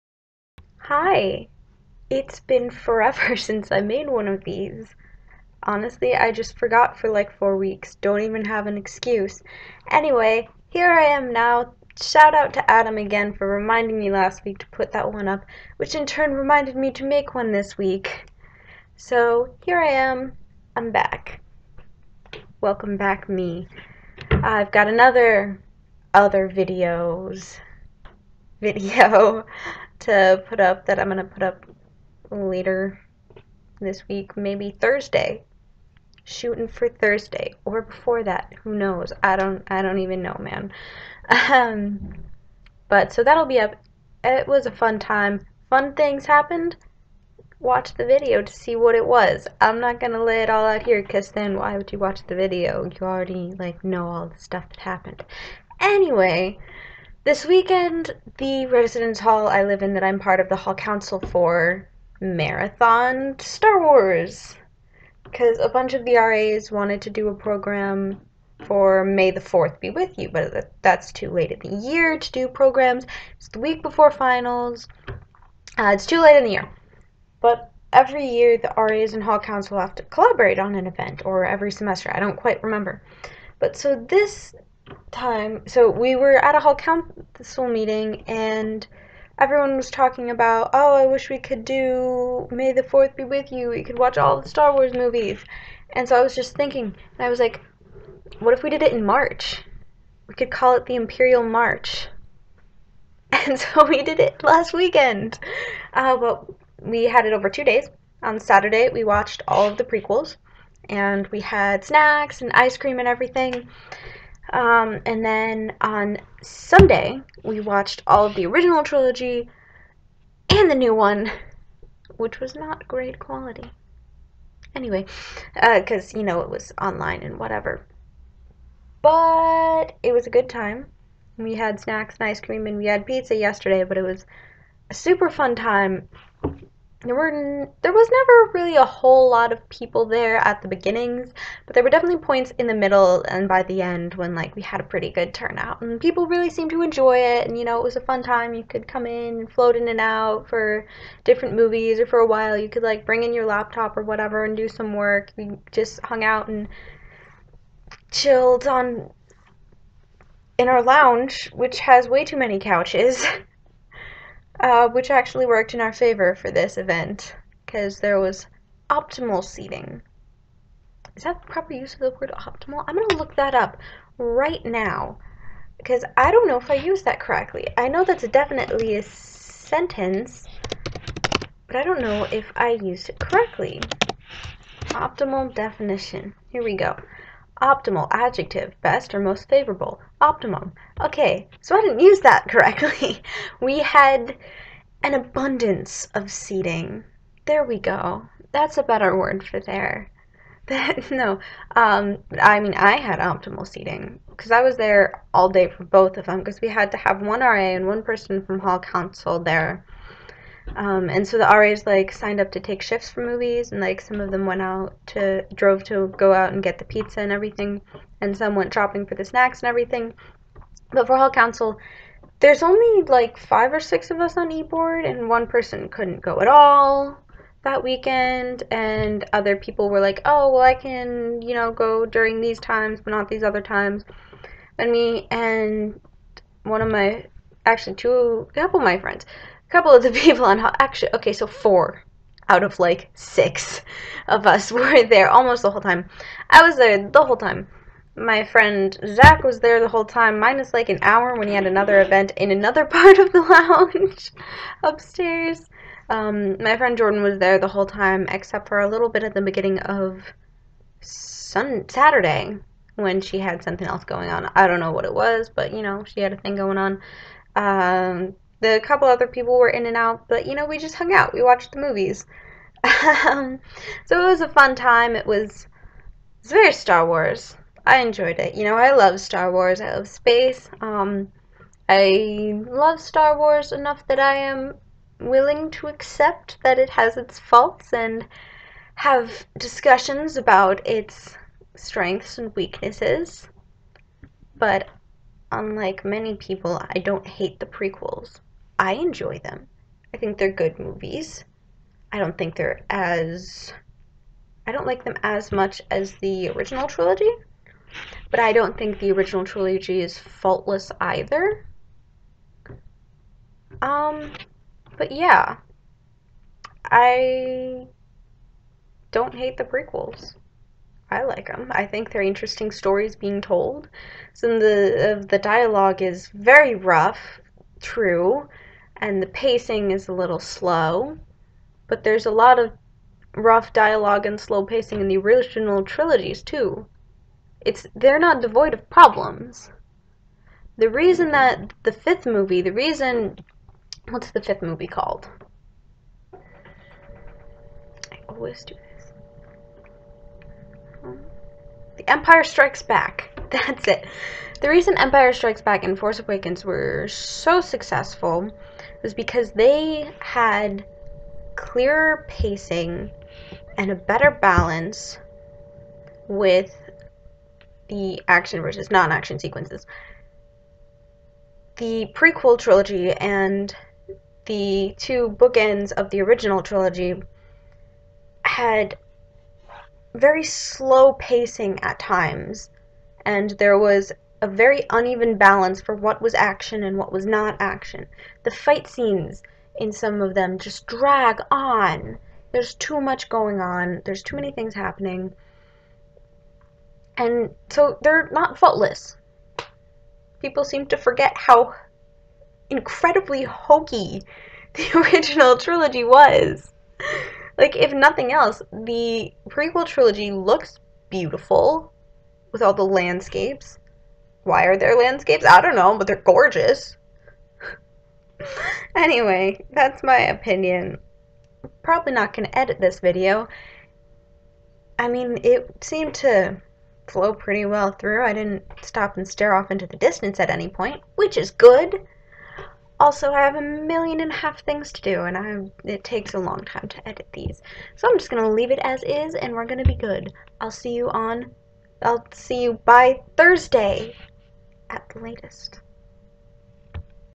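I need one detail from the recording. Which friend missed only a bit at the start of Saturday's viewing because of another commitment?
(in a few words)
Jordan.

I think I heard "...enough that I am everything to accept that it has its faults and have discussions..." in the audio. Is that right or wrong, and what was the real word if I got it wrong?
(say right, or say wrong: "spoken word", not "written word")
wrong: "willing", not "everything".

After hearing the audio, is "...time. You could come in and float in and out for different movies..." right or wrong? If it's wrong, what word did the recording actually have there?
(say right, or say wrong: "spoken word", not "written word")
right.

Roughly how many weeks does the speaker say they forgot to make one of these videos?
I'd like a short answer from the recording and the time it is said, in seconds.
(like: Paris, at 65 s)
4, at 7 s.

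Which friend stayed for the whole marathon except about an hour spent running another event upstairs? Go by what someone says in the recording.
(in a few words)
Zach.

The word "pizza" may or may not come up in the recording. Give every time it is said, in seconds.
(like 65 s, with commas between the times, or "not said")
133 s, 216 s.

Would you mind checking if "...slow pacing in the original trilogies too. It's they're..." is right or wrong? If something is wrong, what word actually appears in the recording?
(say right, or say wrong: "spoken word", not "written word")
right.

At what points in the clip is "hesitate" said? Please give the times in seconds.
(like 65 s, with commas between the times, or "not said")
not said.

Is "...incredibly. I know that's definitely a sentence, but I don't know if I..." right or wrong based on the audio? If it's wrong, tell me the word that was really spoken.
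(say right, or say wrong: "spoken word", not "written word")
wrong: "correctly", not "incredibly".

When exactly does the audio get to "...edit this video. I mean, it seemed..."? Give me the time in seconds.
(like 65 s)
422 s.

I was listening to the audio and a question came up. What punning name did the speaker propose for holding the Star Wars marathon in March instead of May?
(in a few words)
Imperial March.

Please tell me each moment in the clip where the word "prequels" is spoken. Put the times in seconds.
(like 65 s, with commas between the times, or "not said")
109 s, 297 s, 319 s, 372 s, 409 s.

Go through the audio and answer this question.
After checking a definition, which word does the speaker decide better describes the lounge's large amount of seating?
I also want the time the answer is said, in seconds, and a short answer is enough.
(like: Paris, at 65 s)
abundance, at 195 s.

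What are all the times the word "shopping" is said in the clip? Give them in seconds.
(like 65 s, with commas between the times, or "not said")
218 s.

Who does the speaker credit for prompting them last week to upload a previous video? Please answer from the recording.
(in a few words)
Adam.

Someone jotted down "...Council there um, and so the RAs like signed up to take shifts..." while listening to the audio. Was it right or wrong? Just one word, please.
right.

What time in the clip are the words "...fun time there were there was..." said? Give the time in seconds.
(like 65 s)
135 s.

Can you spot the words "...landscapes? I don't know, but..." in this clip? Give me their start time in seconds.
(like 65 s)
414 s.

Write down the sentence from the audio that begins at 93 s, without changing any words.
We could watch all the Star Wars movies.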